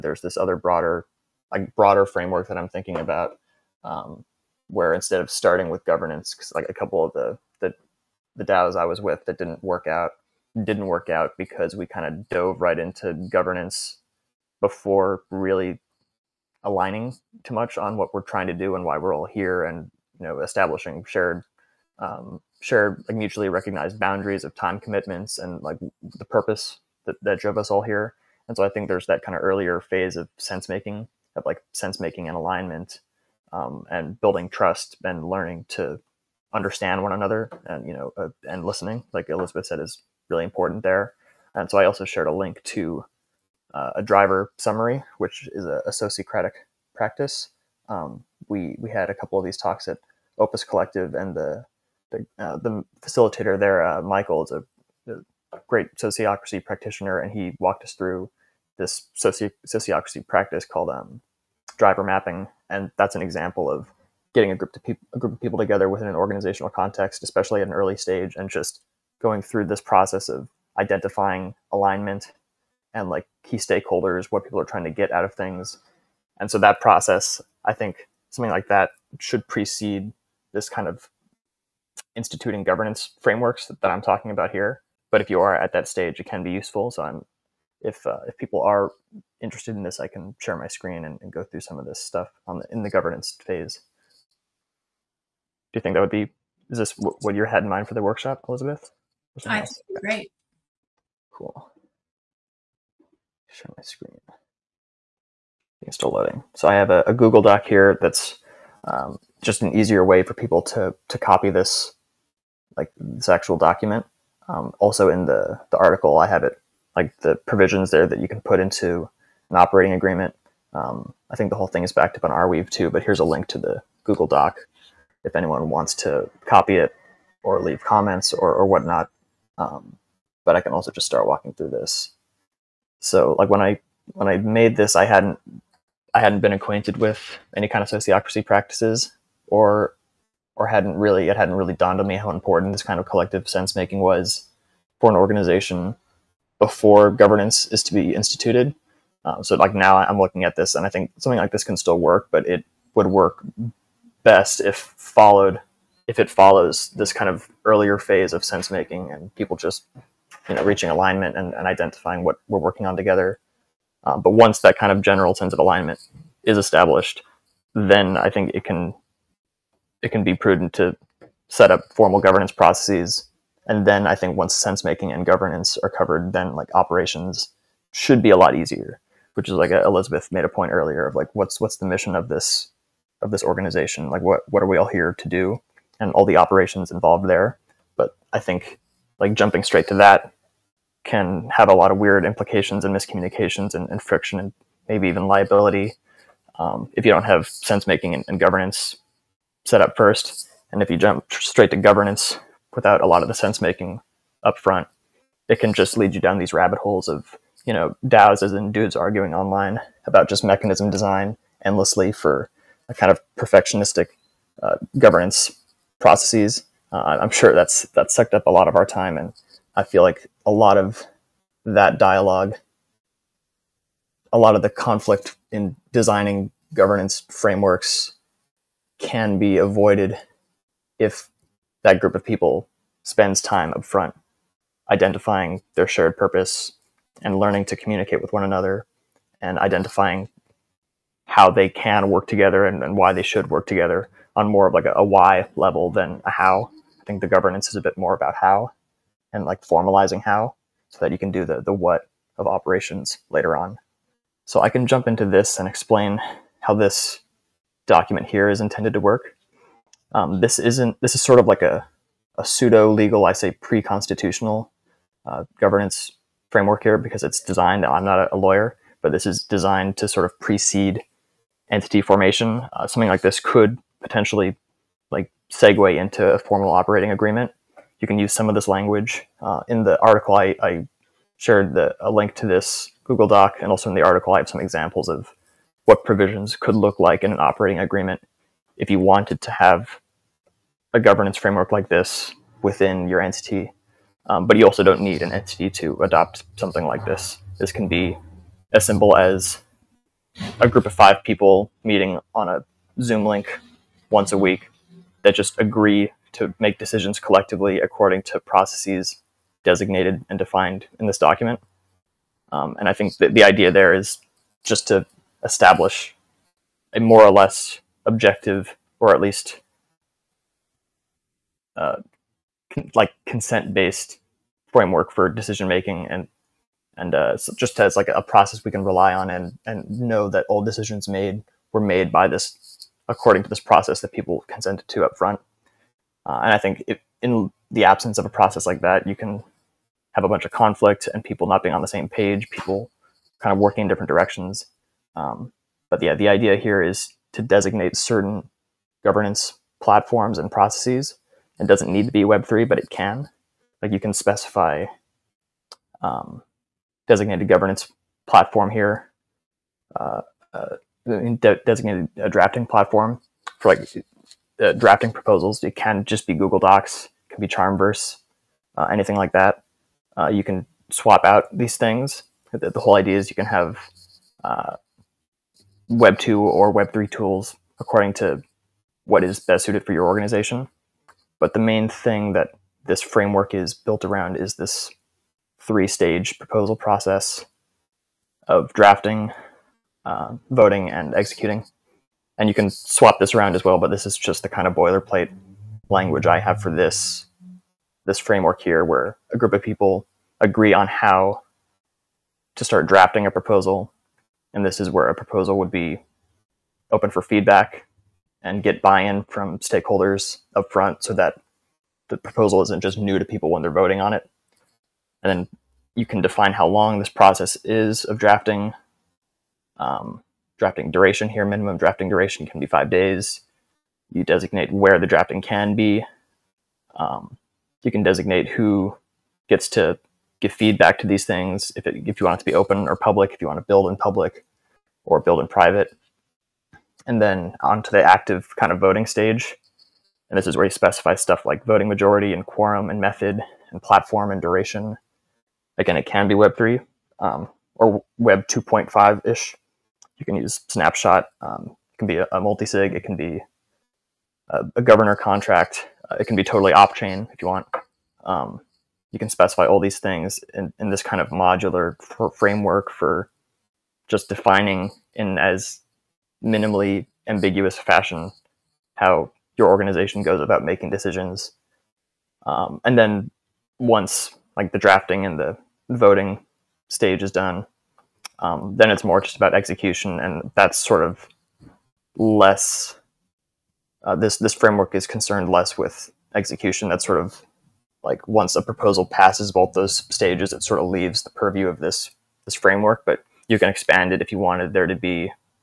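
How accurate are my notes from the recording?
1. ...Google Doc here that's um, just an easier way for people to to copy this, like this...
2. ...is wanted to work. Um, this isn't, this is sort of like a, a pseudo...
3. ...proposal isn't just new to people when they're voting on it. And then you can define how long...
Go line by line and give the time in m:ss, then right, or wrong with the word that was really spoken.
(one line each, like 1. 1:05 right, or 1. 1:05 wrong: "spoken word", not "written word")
1. 1:47 right
2. 4:18 wrong: "intended", not "wanted"
3. 6:52 right.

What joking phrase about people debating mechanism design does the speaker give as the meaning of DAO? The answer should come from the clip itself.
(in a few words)
dudes arguing online.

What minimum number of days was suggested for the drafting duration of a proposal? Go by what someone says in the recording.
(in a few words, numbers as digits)
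5.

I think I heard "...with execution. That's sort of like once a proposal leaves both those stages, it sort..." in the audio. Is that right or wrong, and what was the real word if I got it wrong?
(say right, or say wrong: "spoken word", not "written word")
wrong: "passes", not "leaves".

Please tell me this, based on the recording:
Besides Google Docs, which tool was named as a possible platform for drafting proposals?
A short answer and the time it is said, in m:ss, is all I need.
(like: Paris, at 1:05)
Charmverse, at 6:07.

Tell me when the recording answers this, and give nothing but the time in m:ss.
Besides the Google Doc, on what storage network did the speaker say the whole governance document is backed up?
2:02.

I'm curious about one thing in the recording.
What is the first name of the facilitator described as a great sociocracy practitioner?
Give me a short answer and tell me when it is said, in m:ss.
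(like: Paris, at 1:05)
Michael, at 0:54.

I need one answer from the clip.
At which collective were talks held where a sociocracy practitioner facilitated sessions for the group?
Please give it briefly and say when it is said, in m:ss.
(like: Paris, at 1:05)
Opus Collective, at 0:50.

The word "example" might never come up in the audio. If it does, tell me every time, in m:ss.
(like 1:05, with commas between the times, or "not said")
1:03, 4:44.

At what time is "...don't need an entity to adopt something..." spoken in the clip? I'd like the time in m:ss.
4:54.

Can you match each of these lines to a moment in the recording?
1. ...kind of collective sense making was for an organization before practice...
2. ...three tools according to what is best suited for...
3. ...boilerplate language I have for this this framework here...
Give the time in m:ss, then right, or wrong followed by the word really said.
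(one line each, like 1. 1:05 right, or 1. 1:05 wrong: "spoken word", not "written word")
1. 2:22 wrong: "governance", not "practice"
2. 6:16 right
3. 6:34 right.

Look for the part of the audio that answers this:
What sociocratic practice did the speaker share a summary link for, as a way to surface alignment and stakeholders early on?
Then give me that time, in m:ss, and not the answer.
0:44.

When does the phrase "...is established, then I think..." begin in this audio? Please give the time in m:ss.
2:46.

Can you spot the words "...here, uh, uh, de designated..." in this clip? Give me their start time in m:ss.
5:58.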